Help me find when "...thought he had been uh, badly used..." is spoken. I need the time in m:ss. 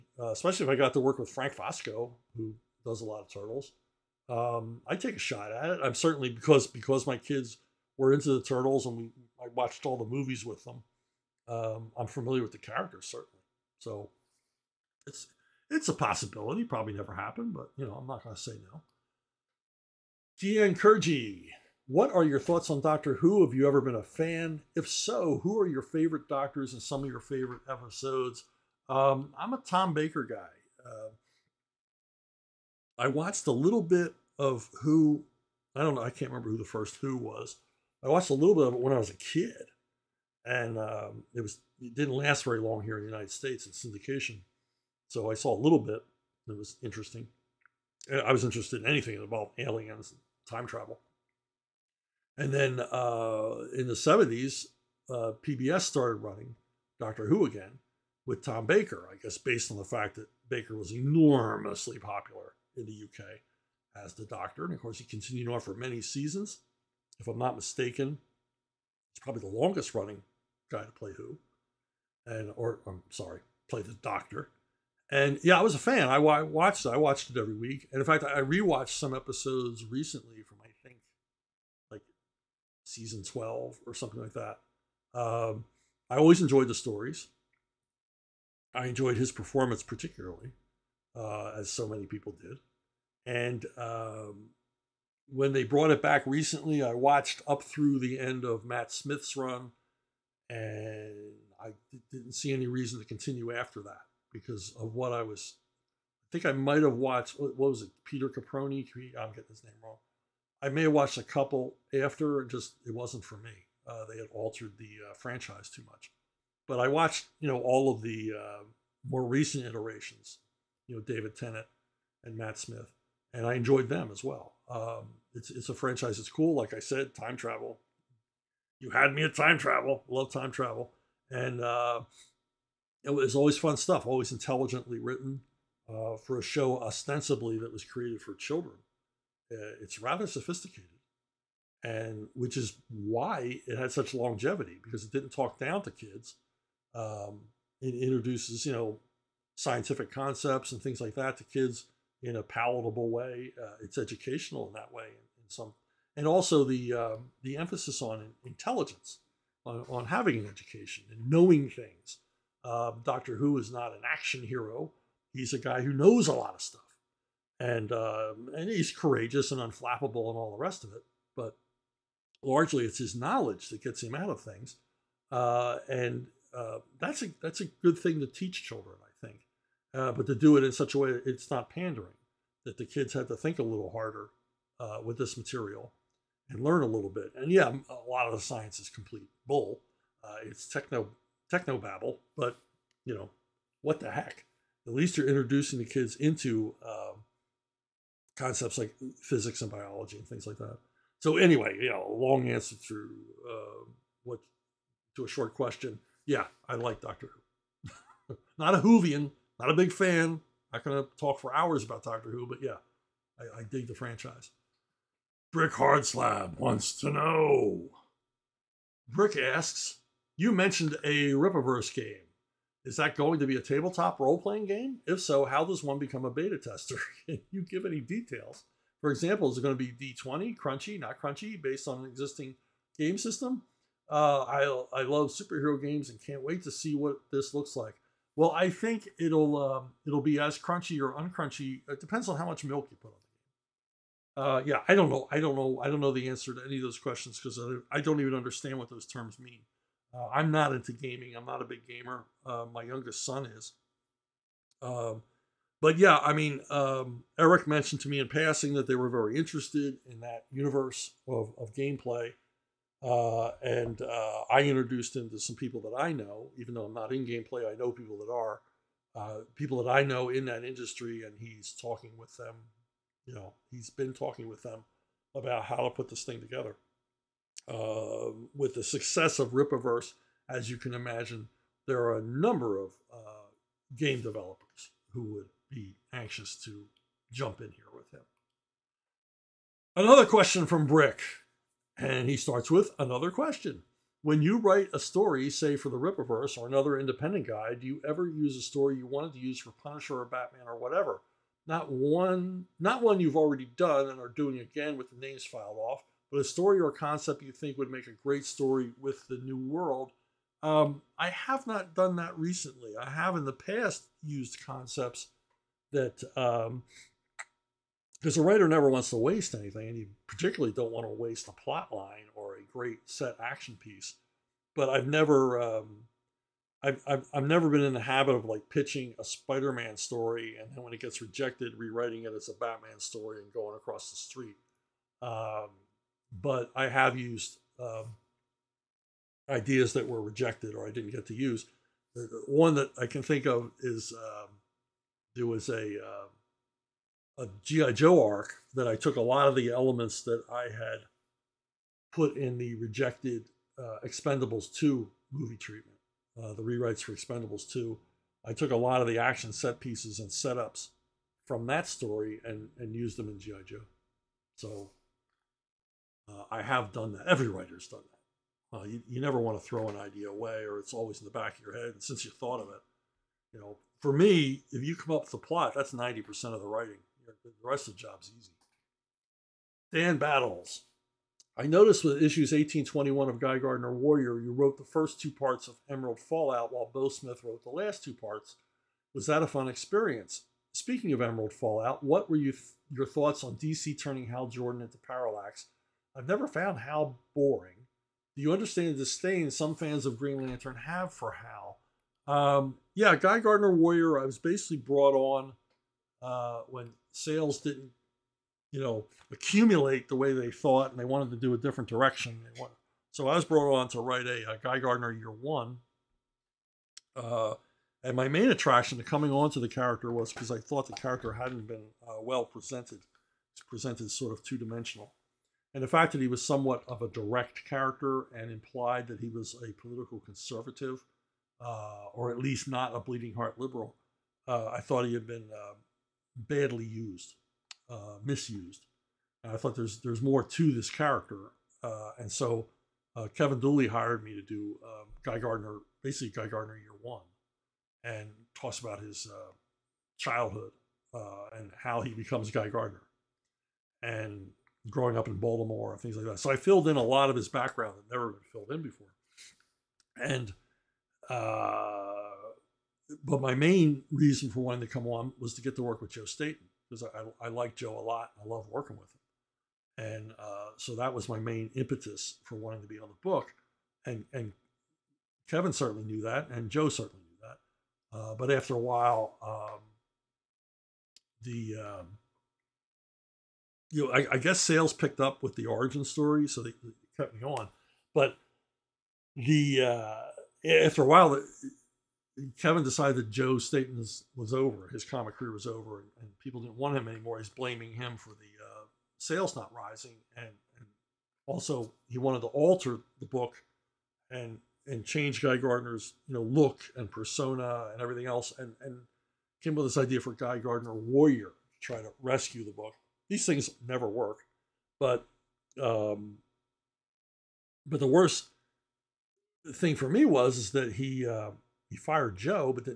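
7:14.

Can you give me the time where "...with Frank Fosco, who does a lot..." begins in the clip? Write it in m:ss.
0:01.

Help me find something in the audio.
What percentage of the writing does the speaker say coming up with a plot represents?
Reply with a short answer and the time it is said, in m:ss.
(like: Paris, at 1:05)
90%, at 6:15.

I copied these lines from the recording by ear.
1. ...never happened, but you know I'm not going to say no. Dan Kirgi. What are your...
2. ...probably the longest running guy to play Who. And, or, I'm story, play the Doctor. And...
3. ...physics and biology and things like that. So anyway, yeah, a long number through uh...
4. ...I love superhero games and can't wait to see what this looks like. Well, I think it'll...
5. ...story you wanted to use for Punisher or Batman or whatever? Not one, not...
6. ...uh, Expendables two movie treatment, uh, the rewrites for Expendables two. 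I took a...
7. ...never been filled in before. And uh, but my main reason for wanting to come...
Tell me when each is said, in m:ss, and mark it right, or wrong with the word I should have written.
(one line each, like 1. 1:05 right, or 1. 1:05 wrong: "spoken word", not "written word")
1. 0:16 right
2. 1:09 wrong: "sorry", not "story"
3. 3:19 wrong: "answer", not "number"
4. 3:54 right
5. 4:58 right
6. 5:53 right
7. 7:38 right.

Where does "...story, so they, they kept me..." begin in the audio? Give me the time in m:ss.
8:06.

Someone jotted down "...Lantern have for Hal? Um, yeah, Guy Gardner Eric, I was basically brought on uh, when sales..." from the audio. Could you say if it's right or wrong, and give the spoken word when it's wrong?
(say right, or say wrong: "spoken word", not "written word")
wrong: "Warrior", not "Eric".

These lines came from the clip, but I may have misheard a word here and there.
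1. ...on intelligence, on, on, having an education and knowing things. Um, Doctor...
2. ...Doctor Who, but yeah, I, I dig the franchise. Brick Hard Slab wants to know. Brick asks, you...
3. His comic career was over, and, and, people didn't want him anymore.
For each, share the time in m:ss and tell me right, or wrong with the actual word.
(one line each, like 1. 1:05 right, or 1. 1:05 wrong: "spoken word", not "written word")
1. 2:38 right
2. 3:32 right
3. 8:14 right.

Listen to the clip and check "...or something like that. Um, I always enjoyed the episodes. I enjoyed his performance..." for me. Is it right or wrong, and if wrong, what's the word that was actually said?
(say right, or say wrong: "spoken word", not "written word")
wrong: "stories", not "episodes".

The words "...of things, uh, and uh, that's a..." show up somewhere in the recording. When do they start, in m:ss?
2:54.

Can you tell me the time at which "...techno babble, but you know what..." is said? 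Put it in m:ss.
3:11.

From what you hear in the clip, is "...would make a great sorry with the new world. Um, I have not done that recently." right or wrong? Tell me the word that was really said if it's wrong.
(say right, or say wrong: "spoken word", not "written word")
wrong: "story", not "sorry".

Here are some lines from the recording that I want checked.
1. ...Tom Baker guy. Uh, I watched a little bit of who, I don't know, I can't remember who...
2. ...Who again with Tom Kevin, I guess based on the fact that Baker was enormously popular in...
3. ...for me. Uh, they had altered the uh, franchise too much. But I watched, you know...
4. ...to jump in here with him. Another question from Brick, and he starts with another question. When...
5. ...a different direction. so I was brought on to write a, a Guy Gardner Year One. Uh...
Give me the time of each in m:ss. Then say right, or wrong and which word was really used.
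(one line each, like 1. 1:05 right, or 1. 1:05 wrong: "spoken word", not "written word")
1. 0:29 right
2. 0:57 wrong: "Baker", not "Kevin"
3. 1:53 right
4. 4:46 right
5. 6:51 right.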